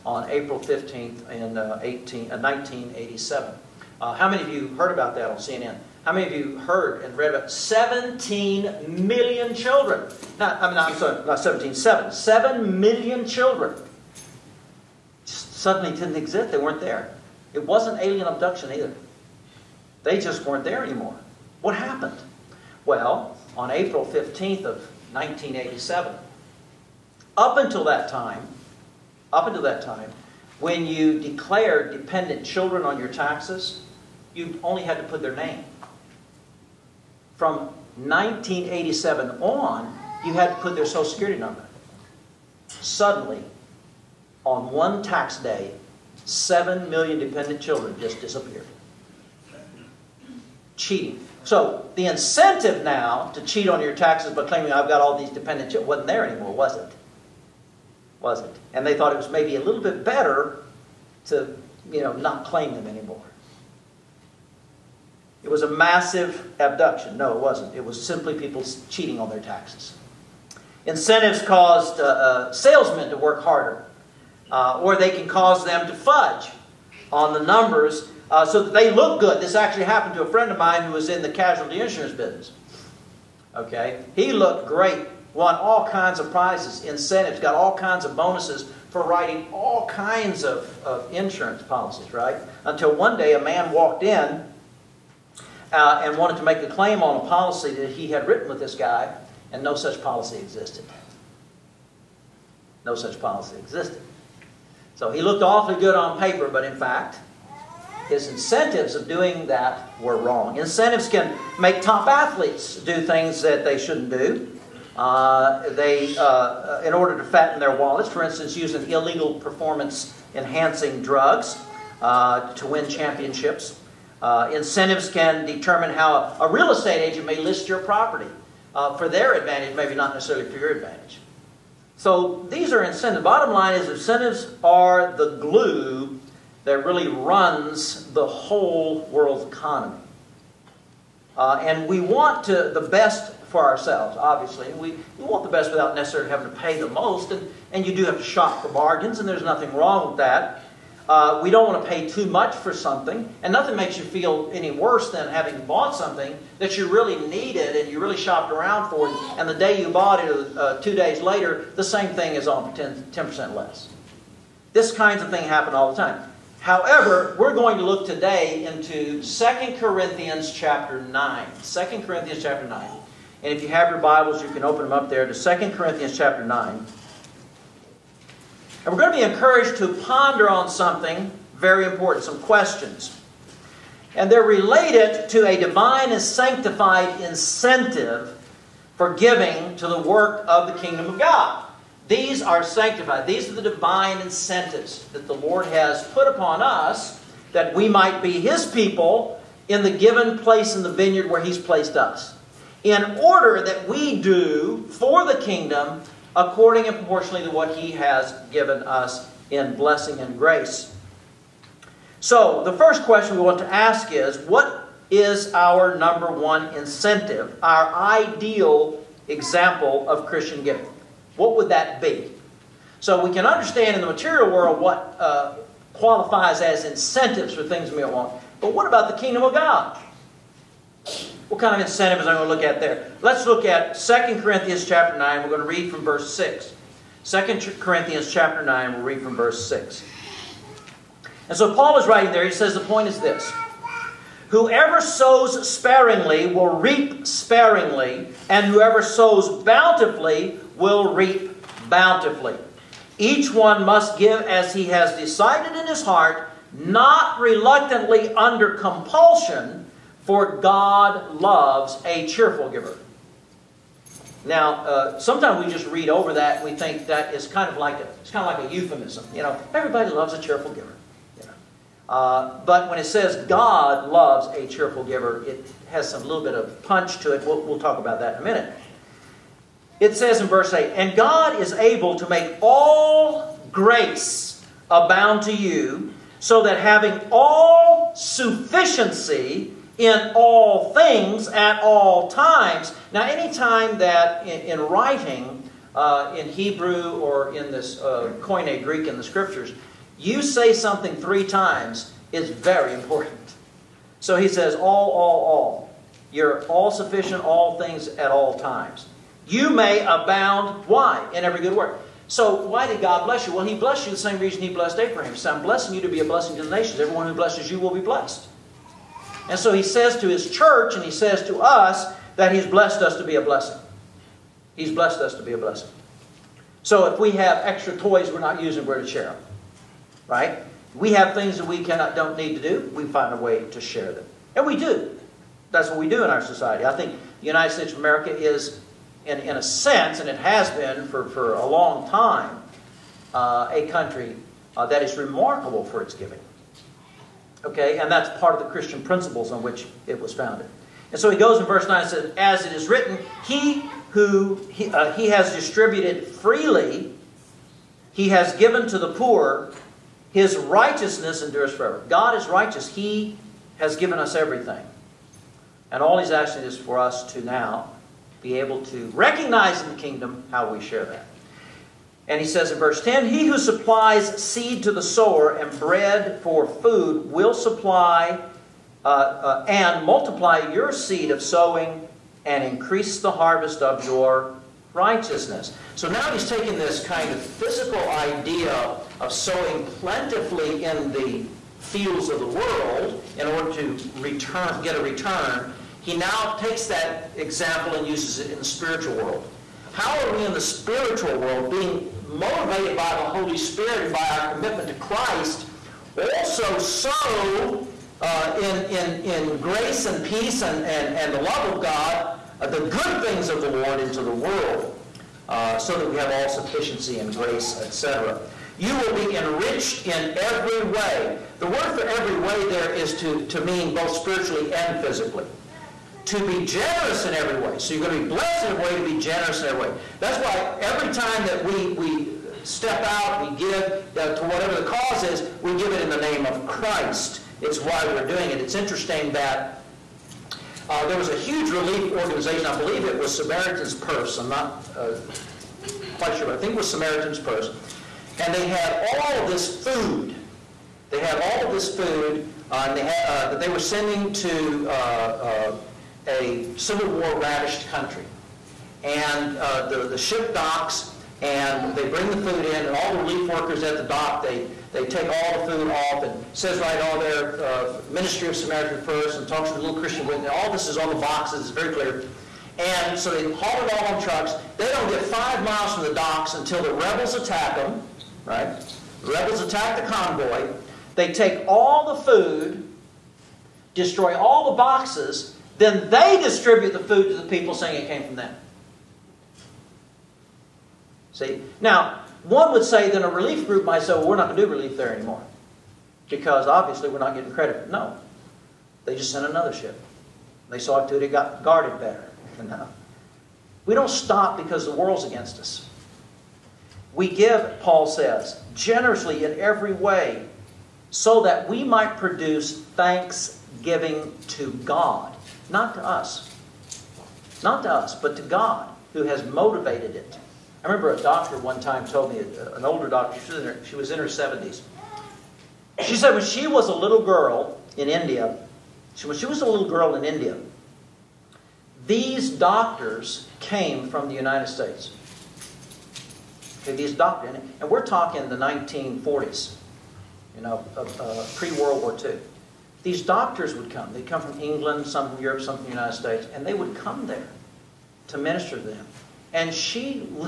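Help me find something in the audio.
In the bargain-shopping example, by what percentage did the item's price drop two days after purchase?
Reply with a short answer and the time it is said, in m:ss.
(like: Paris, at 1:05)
10%, at 2:43.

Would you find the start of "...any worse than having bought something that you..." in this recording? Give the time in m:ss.
2:34.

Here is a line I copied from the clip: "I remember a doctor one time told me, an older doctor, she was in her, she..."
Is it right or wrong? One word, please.
right.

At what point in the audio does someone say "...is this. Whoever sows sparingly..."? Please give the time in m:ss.
4:03.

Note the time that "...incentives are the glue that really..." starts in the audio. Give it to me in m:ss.
2:13.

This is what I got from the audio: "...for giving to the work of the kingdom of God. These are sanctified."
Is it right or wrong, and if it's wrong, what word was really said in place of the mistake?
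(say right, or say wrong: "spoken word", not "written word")
right.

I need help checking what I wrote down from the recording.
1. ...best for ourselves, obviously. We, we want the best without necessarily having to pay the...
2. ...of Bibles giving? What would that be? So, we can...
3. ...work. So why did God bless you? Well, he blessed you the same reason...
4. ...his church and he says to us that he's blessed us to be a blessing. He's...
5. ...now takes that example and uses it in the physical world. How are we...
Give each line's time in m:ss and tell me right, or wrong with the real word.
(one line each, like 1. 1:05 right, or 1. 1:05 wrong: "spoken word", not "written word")
1. 2:22 right
2. 3:40 wrong: "Christian", not "Bibles"
3. 5:11 right
4. 5:20 right
5. 6:36 wrong: "spiritual", not "physical".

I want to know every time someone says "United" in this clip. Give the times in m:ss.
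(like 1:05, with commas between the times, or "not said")
5:37, 8:54, 9:05.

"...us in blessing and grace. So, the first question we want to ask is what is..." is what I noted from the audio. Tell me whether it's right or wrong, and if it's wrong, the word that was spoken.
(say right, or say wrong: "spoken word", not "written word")
right.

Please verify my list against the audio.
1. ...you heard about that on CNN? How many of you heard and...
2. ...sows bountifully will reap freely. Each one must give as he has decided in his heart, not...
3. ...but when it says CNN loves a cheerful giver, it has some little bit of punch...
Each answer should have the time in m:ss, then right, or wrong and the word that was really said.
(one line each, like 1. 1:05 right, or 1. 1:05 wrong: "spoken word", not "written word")
1. 0:04 right
2. 4:09 wrong: "bountifully", not "freely"
3. 4:32 wrong: "God", not "CNN".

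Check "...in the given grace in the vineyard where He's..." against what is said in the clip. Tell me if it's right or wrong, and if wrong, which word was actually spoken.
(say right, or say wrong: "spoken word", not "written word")
wrong: "place", not "grace".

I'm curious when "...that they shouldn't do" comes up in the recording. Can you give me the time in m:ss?
1:53.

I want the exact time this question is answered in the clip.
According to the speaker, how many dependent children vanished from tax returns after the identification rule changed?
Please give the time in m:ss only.
0:12.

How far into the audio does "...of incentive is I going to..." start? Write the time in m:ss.
3:51.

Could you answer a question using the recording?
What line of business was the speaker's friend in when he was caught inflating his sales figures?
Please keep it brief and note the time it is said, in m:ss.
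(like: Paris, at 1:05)
casualty insurance, at 1:21.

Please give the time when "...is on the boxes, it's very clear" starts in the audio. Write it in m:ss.
7:50.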